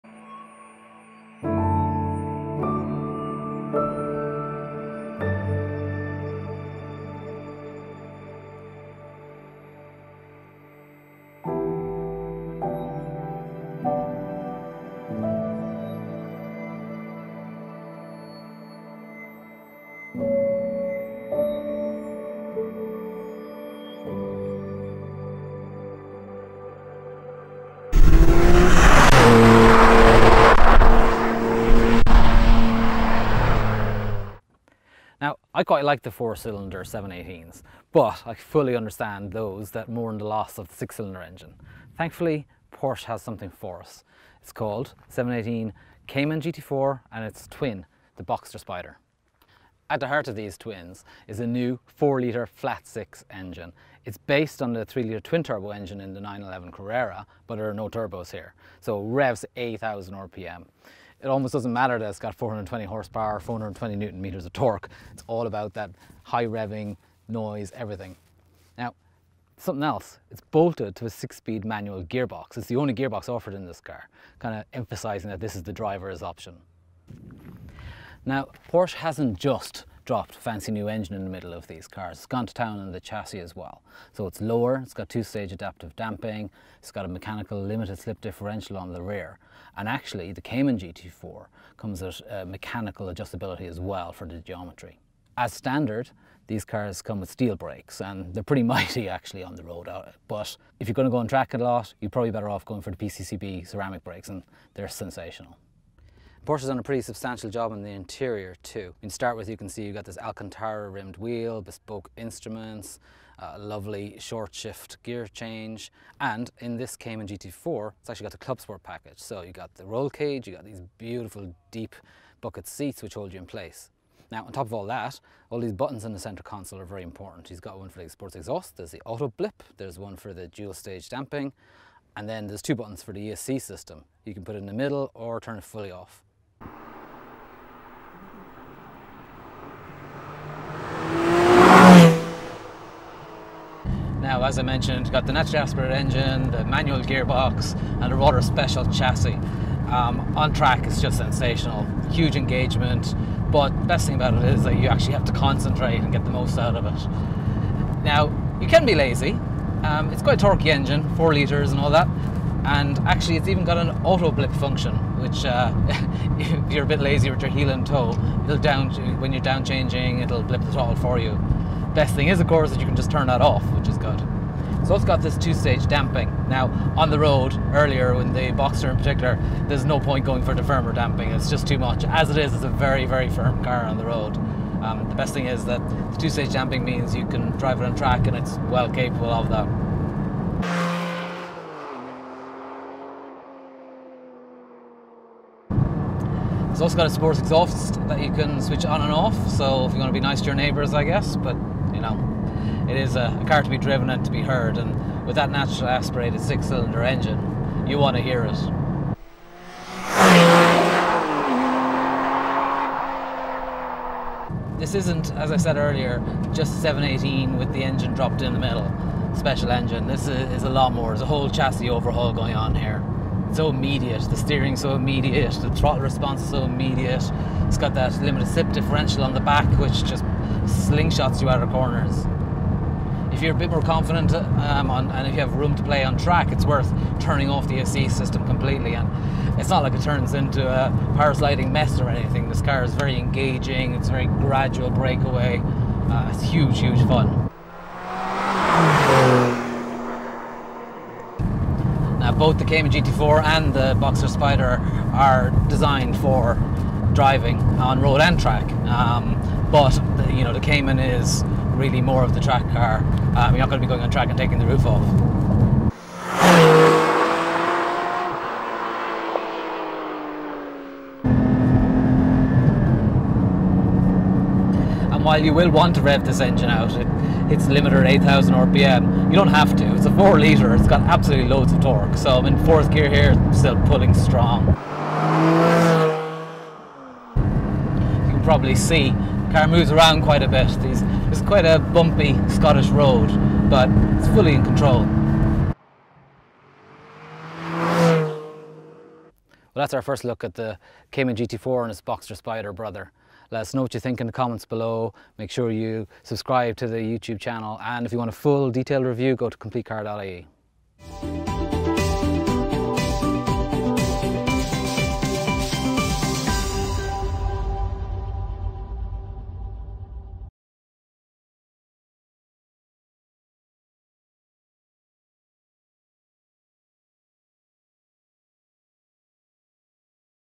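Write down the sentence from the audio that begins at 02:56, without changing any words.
Now, on the road, earlier, when the Boxster in particular, there's no point going for the firmer damping.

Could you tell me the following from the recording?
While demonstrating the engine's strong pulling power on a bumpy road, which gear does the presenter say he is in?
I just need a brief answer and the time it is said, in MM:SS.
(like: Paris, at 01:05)
fourth gear, at 04:42.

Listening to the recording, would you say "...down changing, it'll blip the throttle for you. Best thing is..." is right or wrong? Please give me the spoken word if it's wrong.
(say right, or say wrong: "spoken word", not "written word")
right.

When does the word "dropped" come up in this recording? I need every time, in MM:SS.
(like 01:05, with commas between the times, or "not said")
01:20, 03:38.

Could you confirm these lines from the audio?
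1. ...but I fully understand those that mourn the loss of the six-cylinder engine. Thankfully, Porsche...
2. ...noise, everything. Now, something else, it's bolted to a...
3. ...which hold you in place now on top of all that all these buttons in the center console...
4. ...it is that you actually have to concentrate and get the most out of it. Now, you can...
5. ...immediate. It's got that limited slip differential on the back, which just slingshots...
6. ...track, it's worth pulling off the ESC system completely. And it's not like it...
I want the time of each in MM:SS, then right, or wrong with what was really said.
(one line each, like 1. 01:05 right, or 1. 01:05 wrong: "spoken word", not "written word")
1. 00:37 right
2. 01:07 right
3. 02:03 right
4. 02:34 right
5. 03:46 right
6. 03:56 wrong: "turning", not "pulling".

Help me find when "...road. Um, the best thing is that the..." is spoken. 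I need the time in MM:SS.
03:04.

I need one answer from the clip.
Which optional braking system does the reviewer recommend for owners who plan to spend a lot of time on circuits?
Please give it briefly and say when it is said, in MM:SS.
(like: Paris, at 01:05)
PCCB ceramic brakes, at 01:42.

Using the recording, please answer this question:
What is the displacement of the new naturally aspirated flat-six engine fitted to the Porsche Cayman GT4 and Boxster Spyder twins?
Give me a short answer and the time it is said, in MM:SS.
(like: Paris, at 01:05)
4-litre, at 00:51.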